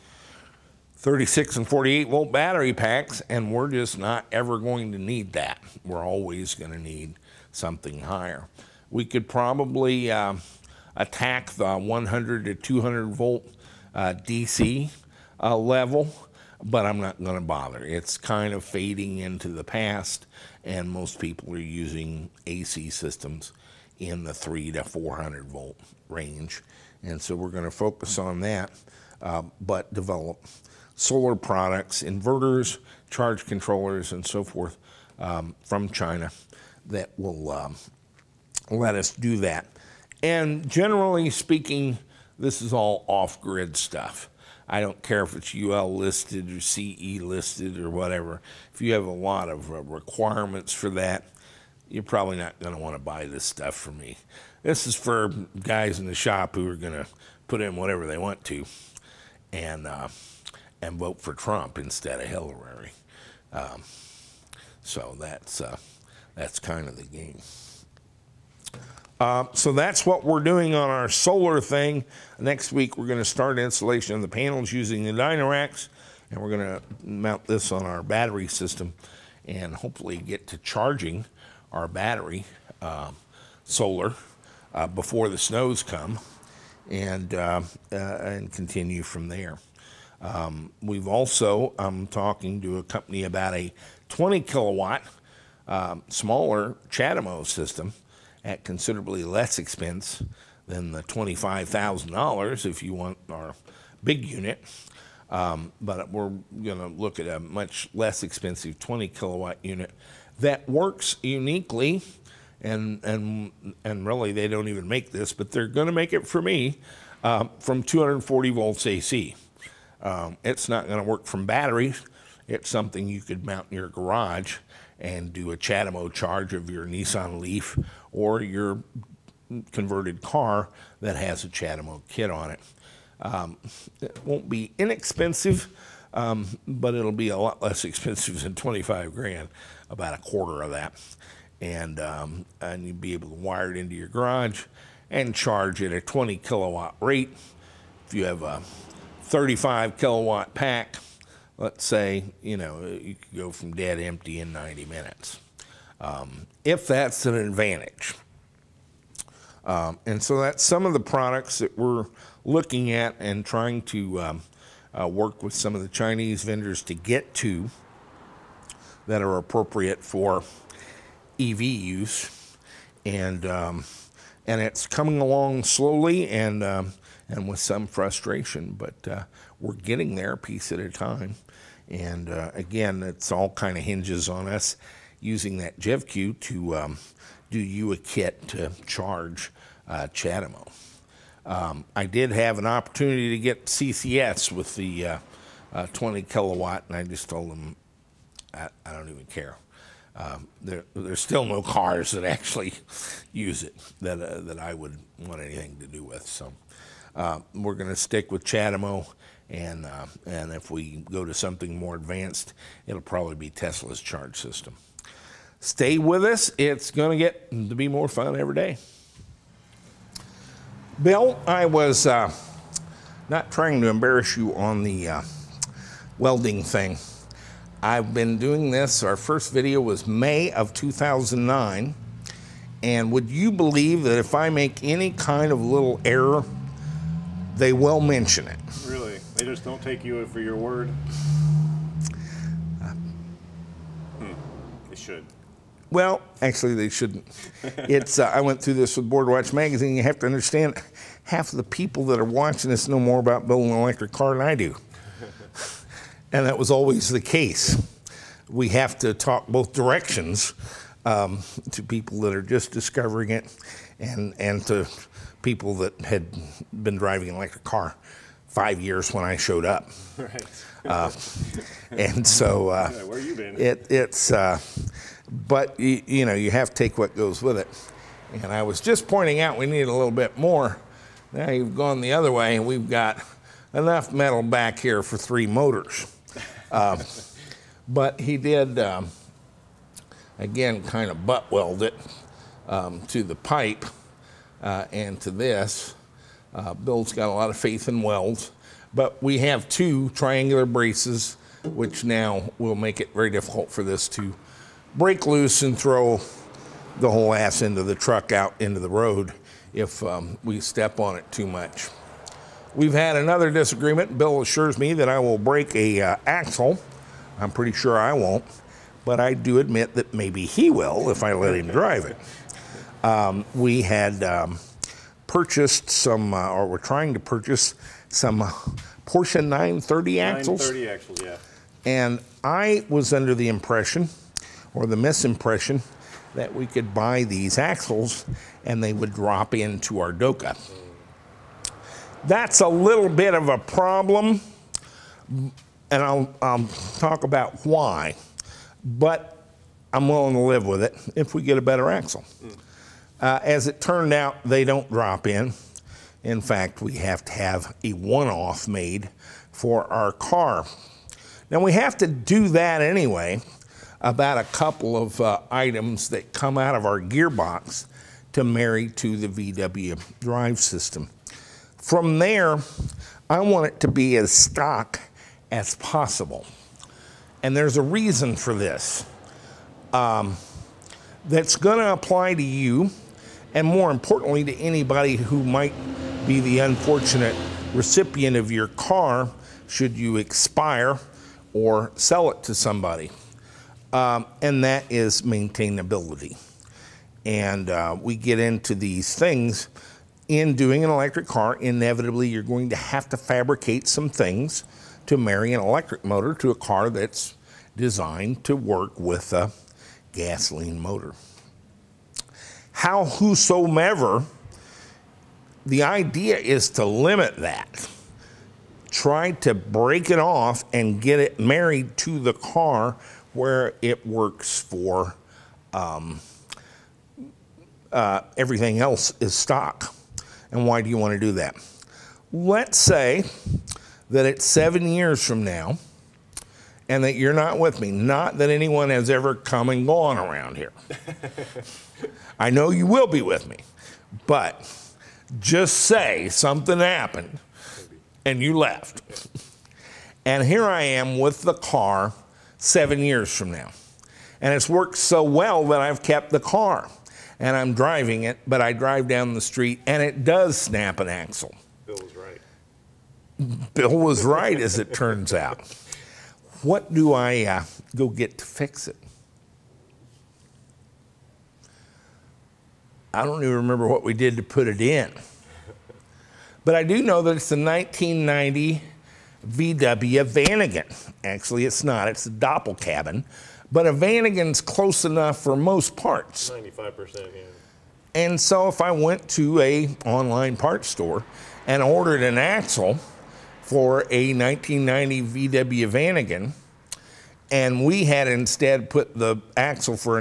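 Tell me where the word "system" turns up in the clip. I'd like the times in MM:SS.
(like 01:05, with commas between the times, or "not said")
00:22, 01:18, 01:37, 03:34, 06:10.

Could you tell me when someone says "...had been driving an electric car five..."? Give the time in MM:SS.
04:26.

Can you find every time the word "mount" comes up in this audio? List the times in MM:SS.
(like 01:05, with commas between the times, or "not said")
01:17, 02:03.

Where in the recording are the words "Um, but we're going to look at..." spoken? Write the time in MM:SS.
01:45.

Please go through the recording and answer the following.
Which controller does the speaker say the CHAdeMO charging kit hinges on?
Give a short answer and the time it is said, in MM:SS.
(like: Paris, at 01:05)
GEVCU, at 03:05.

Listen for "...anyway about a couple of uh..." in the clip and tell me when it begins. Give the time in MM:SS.
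06:02.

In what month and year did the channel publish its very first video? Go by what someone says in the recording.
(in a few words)
May 2009.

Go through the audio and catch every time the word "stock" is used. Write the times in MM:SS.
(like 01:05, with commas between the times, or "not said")
06:14, 07:09.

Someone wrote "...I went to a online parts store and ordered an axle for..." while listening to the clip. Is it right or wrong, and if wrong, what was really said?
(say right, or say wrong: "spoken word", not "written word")
right.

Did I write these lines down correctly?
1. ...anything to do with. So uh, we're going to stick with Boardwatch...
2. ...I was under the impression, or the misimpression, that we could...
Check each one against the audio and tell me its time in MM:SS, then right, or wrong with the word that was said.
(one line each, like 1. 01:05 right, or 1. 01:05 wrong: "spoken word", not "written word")
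1. 03:25 wrong: "CHAdeMO", not "Boardwatch"
2. 05:32 right.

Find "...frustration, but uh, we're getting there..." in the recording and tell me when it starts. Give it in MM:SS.
02:57.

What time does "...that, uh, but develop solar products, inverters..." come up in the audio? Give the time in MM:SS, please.
00:28.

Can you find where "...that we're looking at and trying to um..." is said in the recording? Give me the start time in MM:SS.
02:41.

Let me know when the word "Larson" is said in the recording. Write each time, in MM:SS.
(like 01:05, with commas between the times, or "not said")
not said.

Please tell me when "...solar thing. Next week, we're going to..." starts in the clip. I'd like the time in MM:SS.
01:11.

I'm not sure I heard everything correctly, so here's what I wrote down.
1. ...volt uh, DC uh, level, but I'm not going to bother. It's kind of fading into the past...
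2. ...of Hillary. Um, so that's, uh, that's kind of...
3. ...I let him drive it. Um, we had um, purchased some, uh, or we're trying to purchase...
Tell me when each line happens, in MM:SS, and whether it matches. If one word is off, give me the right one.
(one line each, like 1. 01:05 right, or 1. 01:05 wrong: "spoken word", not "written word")
1. 00:13 right
2. 01:02 right
3. 05:21 right.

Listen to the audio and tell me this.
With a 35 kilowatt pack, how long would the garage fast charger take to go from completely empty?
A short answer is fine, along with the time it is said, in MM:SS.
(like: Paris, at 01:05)
90 minutes, at 02:34.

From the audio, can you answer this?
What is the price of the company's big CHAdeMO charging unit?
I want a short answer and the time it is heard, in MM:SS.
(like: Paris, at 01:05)
$25,000, at 01:41.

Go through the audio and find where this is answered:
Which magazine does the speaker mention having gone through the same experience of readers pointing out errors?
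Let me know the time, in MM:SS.
04:09.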